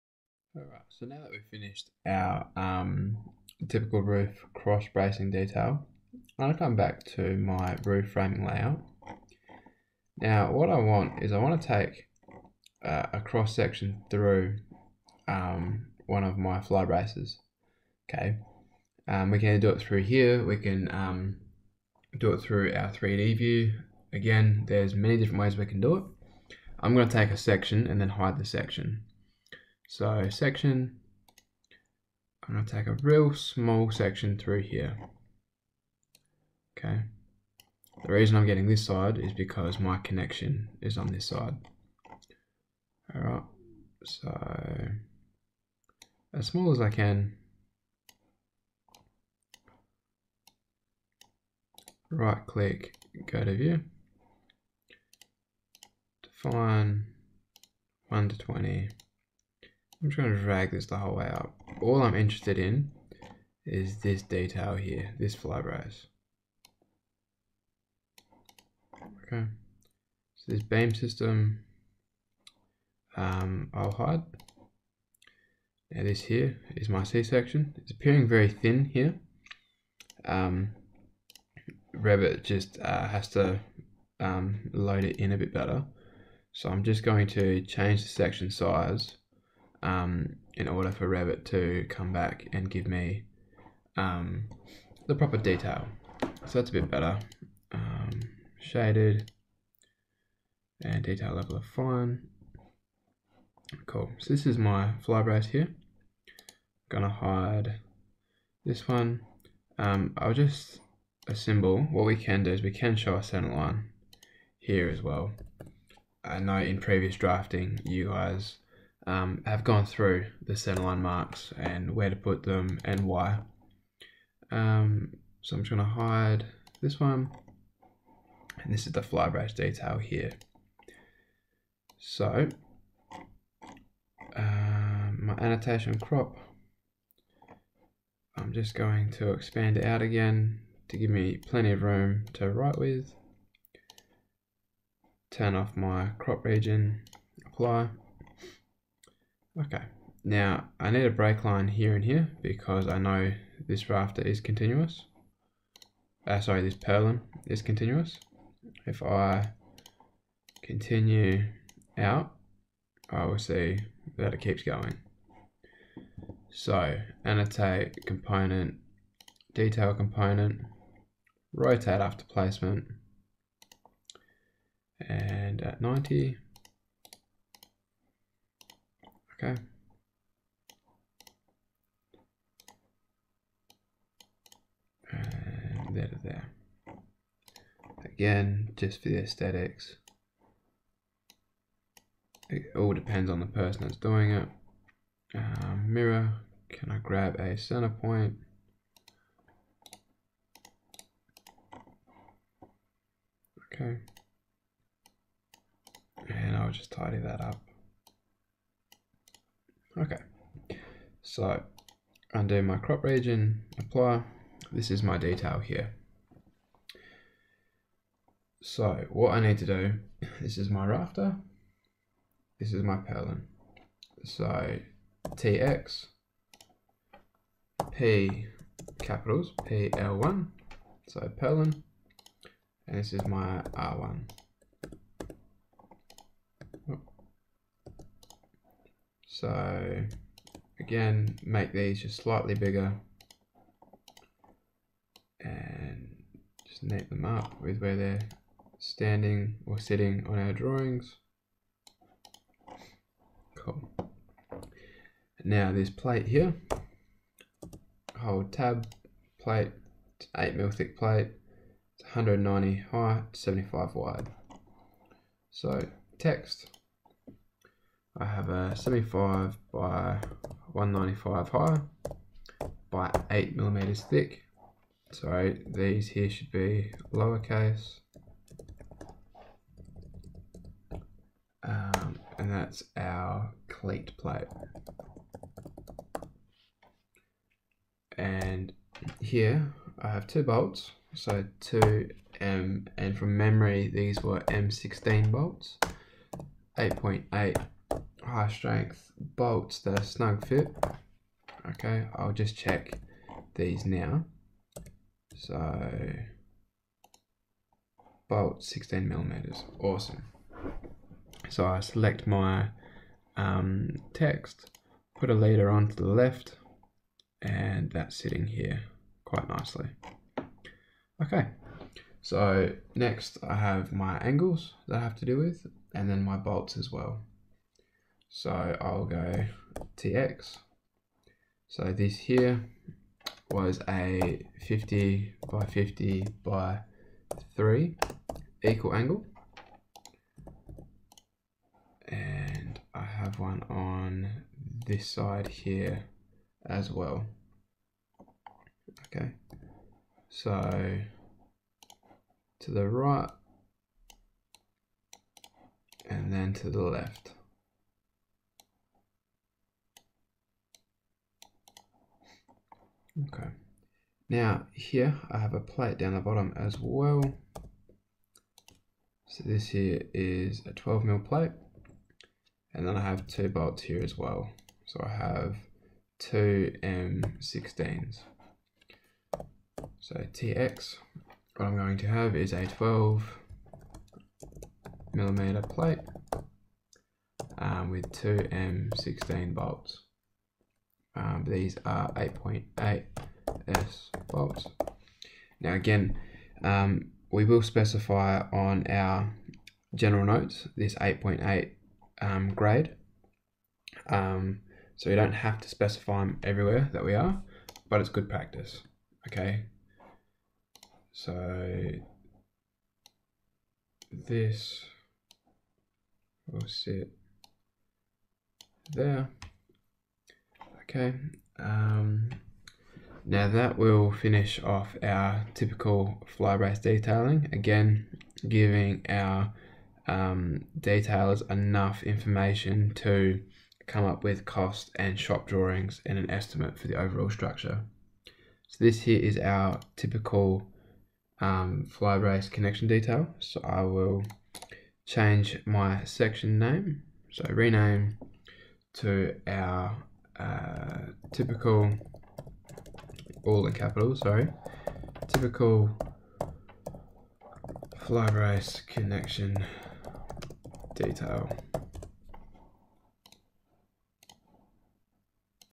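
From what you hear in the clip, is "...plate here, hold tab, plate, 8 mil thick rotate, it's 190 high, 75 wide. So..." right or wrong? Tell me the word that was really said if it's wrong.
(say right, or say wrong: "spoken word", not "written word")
wrong: "plate", not "rotate".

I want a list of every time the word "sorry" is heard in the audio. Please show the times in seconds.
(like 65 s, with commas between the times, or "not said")
156 s, 454 s.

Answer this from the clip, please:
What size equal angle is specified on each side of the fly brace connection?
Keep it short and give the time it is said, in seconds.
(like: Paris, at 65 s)
50 by 50 by 3, at 334 s.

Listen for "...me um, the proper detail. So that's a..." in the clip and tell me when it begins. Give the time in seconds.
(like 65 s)
92 s.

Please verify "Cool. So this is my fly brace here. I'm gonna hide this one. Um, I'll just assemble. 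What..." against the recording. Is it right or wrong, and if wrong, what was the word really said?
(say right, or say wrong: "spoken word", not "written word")
right.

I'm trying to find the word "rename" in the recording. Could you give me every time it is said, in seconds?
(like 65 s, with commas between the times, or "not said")
447 s.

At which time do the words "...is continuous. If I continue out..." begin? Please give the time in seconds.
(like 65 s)
157 s.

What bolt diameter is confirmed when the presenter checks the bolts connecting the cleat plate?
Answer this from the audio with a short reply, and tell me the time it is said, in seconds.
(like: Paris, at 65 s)
16 mm, at 308 s.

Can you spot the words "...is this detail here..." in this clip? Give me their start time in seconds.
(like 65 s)
63 s.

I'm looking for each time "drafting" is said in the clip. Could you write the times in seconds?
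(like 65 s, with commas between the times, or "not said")
117 s.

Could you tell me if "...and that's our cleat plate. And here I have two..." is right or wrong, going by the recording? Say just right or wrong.
right.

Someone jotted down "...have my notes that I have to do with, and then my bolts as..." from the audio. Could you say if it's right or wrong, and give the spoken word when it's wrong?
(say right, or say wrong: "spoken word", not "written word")
wrong: "angles", not "notes".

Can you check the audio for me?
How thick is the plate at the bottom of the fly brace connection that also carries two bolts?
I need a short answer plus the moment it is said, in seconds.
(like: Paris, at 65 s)
12 mm, at 370 s.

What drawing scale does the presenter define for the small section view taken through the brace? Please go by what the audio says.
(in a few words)
1 to 20.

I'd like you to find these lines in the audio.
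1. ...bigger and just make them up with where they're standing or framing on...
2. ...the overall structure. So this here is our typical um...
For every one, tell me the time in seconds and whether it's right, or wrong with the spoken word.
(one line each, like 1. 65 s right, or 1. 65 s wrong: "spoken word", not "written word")
1. 242 s wrong: "sitting", not "framing"
2. 436 s right.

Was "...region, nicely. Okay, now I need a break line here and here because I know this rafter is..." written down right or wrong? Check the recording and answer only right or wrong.
wrong.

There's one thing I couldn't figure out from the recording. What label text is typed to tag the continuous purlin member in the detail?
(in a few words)
PL1.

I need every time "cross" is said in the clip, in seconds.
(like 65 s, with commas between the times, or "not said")
4 s, 13 s.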